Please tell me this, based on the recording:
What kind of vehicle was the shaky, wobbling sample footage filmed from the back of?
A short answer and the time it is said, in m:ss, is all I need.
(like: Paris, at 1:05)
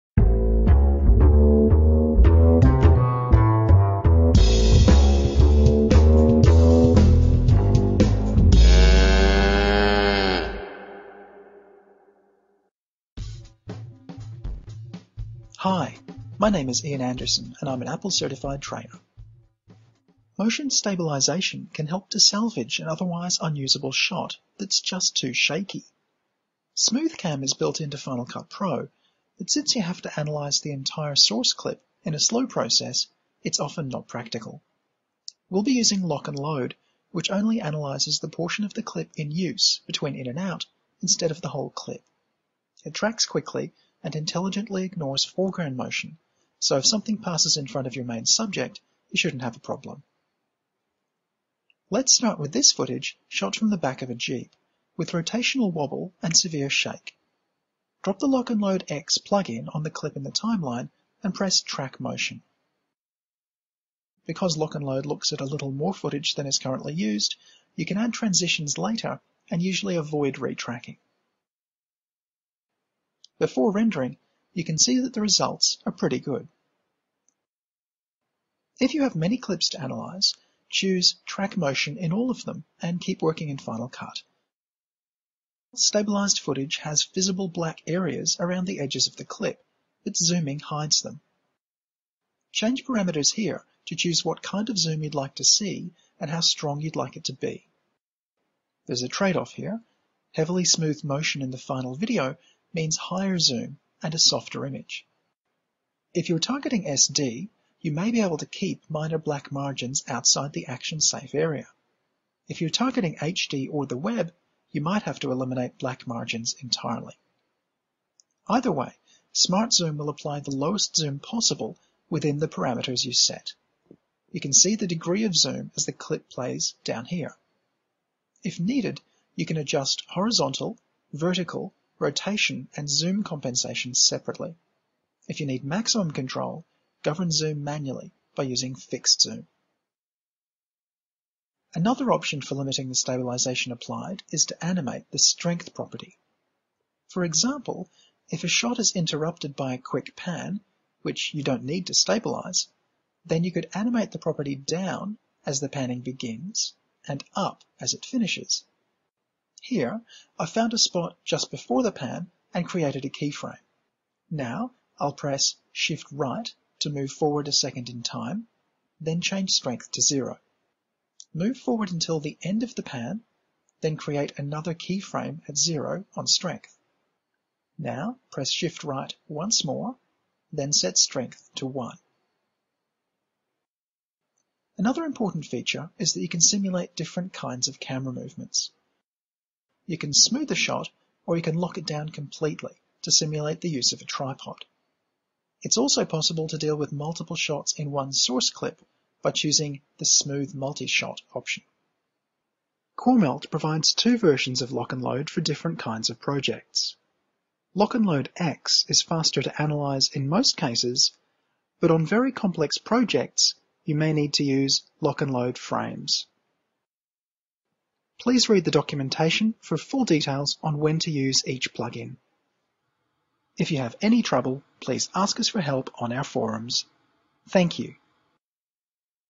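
Jeep, at 0:54.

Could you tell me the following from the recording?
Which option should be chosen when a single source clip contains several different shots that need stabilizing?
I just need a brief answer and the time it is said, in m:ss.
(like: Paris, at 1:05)
Smooth Multi-Shot, at 3:20.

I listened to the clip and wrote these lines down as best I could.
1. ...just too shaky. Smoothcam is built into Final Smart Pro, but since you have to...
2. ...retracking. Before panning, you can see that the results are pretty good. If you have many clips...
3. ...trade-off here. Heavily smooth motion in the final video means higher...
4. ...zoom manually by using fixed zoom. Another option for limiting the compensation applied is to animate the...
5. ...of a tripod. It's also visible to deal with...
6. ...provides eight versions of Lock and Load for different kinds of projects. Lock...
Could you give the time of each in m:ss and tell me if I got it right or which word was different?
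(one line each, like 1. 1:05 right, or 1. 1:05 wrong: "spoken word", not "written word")
1. 0:24 wrong: "Cut", not "Smart"
2. 1:10 wrong: "rendering", not "panning"
3. 1:39 right
4. 2:17 wrong: "stabilization", not "compensation"
5. 3:13 wrong: "possible", not "visible"
6. 3:23 wrong: "two", not "eight".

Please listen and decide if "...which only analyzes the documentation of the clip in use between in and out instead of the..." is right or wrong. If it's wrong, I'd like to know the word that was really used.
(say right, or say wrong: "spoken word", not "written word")
wrong: "portion", not "documentation".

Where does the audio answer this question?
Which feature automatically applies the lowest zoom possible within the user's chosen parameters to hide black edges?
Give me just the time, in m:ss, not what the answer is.
1:59.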